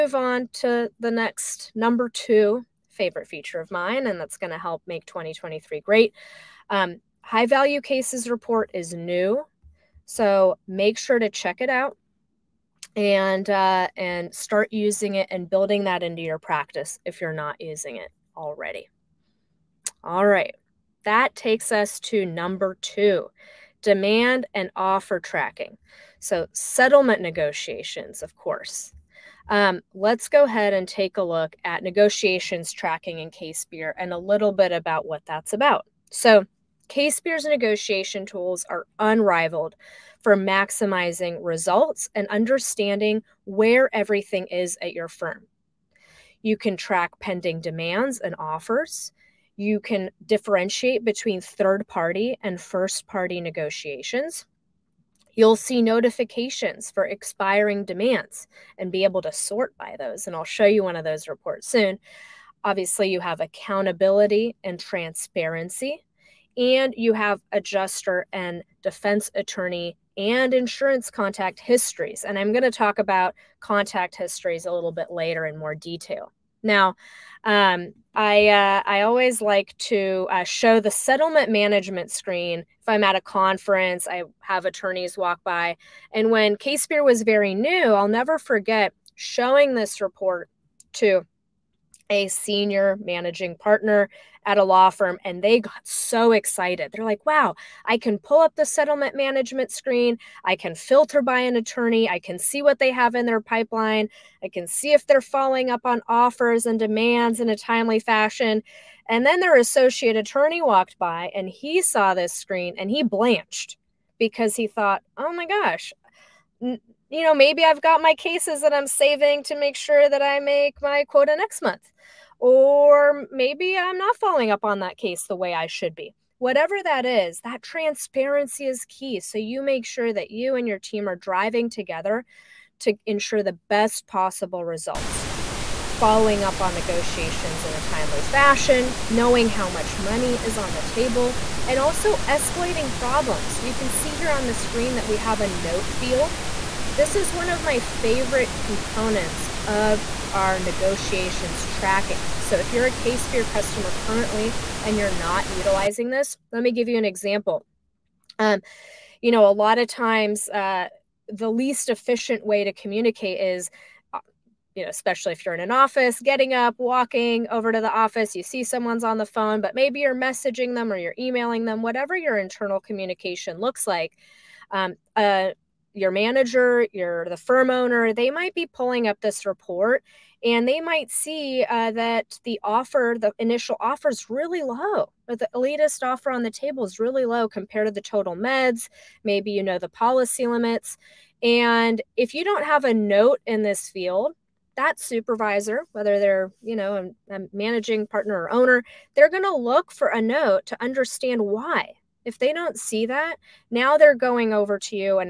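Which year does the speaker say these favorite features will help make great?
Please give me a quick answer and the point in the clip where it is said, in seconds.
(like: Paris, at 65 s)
2023, at 5 s.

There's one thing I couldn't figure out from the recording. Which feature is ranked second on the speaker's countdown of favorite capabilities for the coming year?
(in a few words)
Demand and offer tracking.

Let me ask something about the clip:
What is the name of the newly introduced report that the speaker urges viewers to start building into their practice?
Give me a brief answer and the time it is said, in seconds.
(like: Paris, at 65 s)
High Value Cases Report, at 7 s.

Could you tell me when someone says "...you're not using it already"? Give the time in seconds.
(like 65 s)
17 s.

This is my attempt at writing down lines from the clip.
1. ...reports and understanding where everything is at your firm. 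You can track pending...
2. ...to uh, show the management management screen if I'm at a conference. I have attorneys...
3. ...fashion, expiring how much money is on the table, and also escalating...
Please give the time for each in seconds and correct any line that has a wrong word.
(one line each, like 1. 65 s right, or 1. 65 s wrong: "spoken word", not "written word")
1. 41 s wrong: "results", not "reports"
2. 79 s wrong: "settlement", not "management"
3. 138 s wrong: "knowing", not "expiring".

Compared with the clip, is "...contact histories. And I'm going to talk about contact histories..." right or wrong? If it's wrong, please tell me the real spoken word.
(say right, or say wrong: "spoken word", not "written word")
right.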